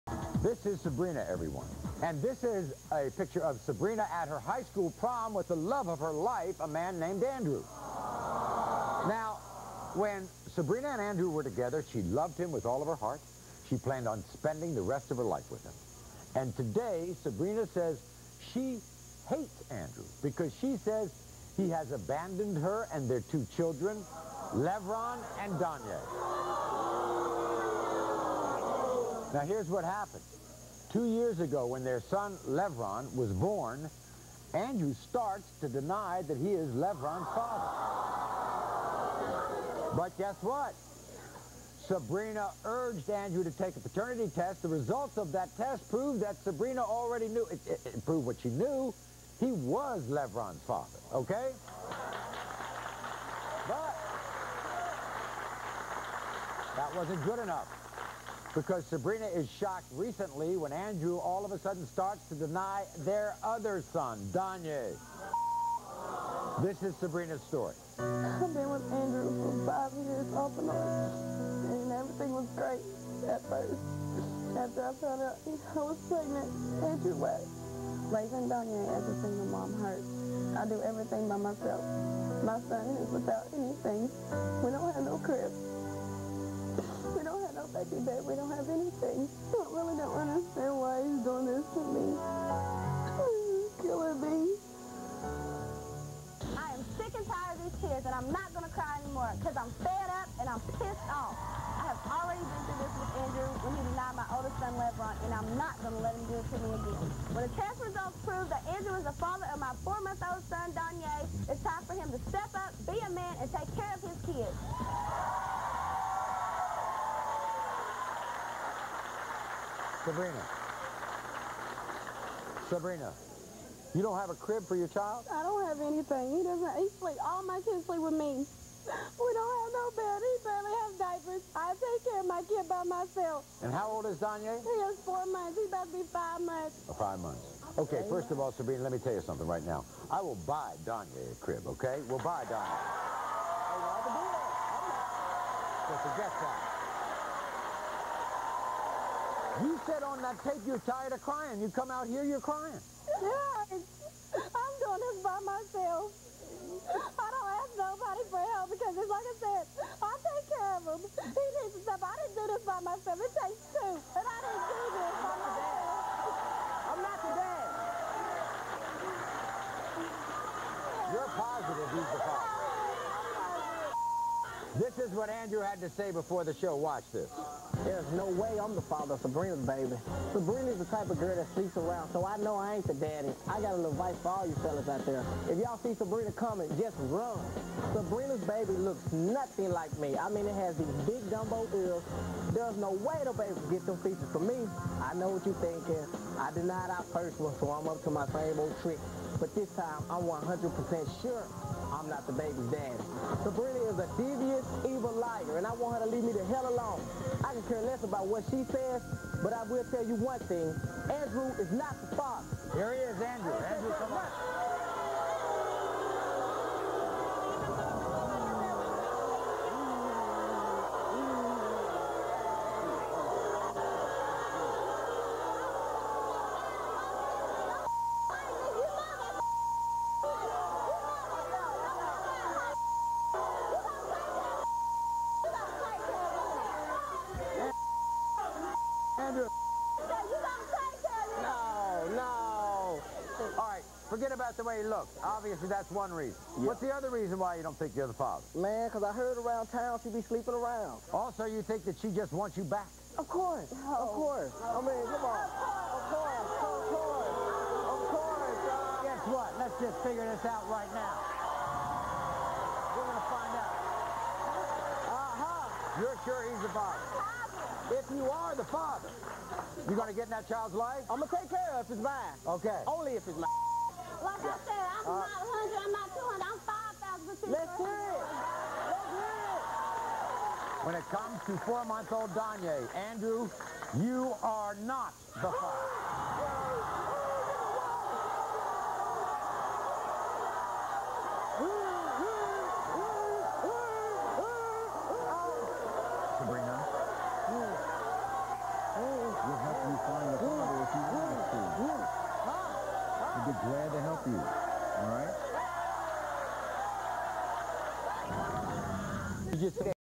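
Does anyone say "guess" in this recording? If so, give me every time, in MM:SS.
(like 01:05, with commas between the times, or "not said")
00:40, 04:19.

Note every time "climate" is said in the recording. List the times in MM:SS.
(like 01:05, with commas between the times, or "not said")
not said.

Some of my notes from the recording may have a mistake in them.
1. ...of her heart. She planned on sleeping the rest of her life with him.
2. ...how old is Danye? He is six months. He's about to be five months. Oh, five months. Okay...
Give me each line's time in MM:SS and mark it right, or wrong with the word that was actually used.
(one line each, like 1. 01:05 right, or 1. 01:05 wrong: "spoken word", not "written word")
1. 00:12 wrong: "spending", not "sleeping"
2. 02:13 wrong: "four", not "six".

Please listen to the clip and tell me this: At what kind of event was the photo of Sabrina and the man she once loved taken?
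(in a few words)
High school prom.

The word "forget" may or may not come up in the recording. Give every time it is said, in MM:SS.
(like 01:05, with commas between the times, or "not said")
02:26, 04:04.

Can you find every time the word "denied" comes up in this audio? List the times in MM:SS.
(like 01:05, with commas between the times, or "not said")
01:43, 03:16.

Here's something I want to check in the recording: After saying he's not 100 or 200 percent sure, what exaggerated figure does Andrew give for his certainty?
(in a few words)
5,000.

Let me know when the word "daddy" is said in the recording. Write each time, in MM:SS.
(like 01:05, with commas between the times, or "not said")
03:02, 03:22.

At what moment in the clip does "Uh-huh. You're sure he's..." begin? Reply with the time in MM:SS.
04:25.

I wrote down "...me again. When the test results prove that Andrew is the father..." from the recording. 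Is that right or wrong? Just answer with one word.
right.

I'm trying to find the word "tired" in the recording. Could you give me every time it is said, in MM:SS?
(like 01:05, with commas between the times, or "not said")
01:37, 02:30.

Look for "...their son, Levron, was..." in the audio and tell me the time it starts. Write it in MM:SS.
00:31.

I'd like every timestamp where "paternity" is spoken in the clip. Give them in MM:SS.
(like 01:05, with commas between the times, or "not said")
00:43.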